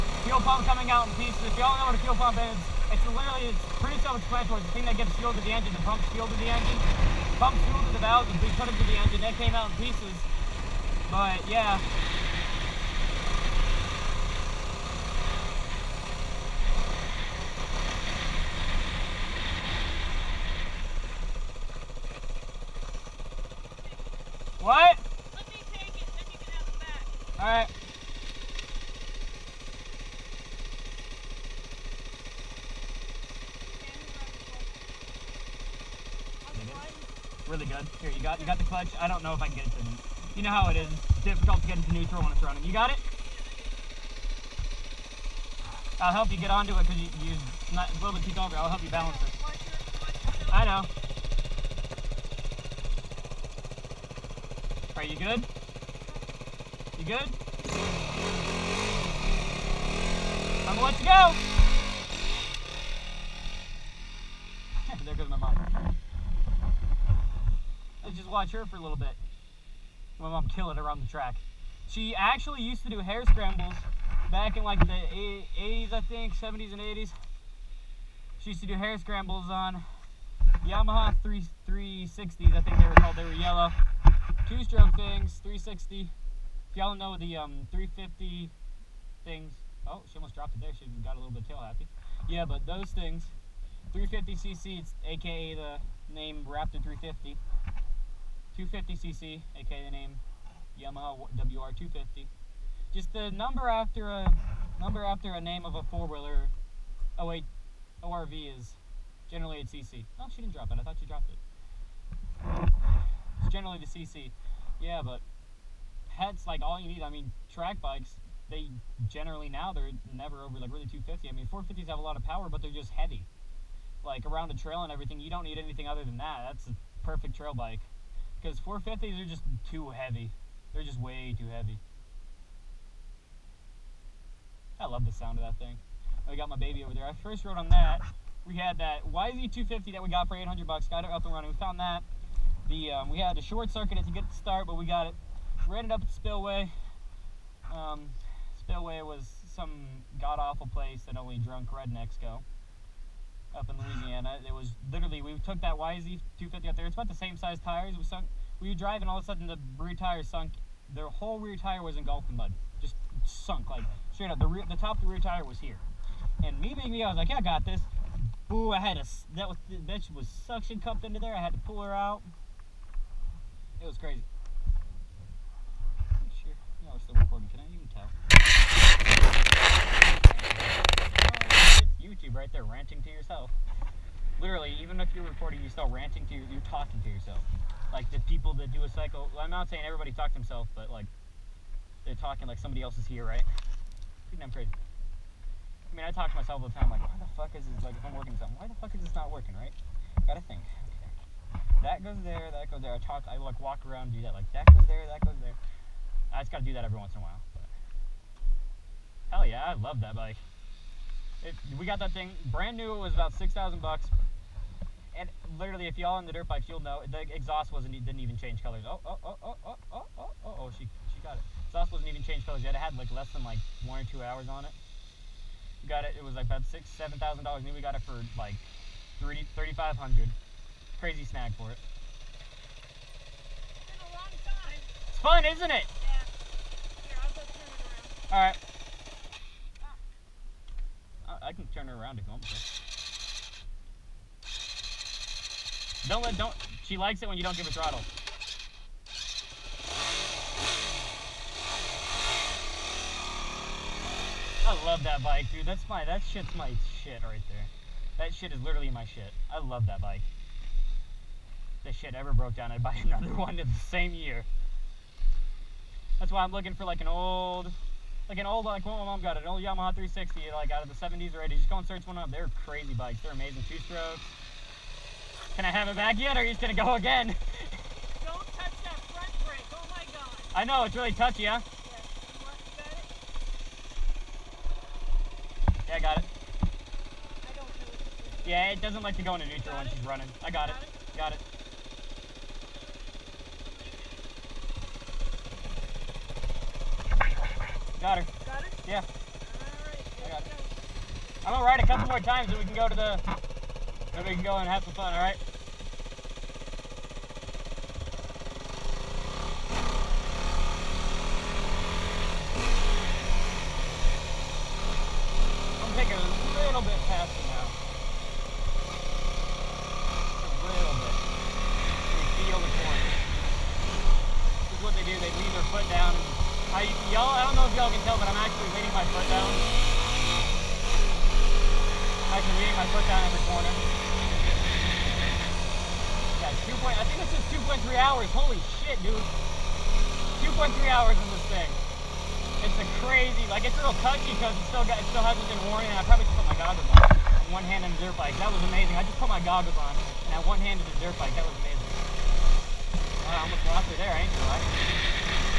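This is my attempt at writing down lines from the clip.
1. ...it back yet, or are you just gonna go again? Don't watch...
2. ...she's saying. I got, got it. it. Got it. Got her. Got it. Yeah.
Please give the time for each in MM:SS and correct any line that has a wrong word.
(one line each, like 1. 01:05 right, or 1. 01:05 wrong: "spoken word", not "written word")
1. 04:35 wrong: "touch", not "watch"
2. 04:49 wrong: "running", not "saying".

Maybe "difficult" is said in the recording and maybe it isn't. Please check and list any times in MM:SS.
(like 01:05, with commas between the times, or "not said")
00:41.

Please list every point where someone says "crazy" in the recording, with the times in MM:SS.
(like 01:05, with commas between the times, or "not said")
02:53, 03:14, 03:50, 04:32, 05:43.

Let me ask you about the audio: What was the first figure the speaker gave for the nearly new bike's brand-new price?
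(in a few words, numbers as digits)
6,000 dollars.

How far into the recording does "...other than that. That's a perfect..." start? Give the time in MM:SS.
02:05.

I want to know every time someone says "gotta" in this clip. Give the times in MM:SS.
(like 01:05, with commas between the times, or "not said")
03:20, 03:26.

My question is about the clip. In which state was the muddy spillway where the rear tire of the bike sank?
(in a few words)
Louisiana.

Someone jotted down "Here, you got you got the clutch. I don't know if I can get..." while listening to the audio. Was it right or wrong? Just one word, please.
right.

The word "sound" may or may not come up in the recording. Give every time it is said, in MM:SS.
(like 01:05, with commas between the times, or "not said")
02:15.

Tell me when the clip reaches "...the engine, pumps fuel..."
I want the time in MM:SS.
00:06.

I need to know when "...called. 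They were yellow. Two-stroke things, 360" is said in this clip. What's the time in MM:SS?
01:22.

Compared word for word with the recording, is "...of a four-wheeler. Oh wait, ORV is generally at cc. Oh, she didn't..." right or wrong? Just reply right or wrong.
right.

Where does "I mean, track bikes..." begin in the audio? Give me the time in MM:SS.
01:57.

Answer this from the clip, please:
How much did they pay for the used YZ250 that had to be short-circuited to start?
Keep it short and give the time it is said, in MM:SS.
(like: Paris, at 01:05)
800 bucks, at 02:20.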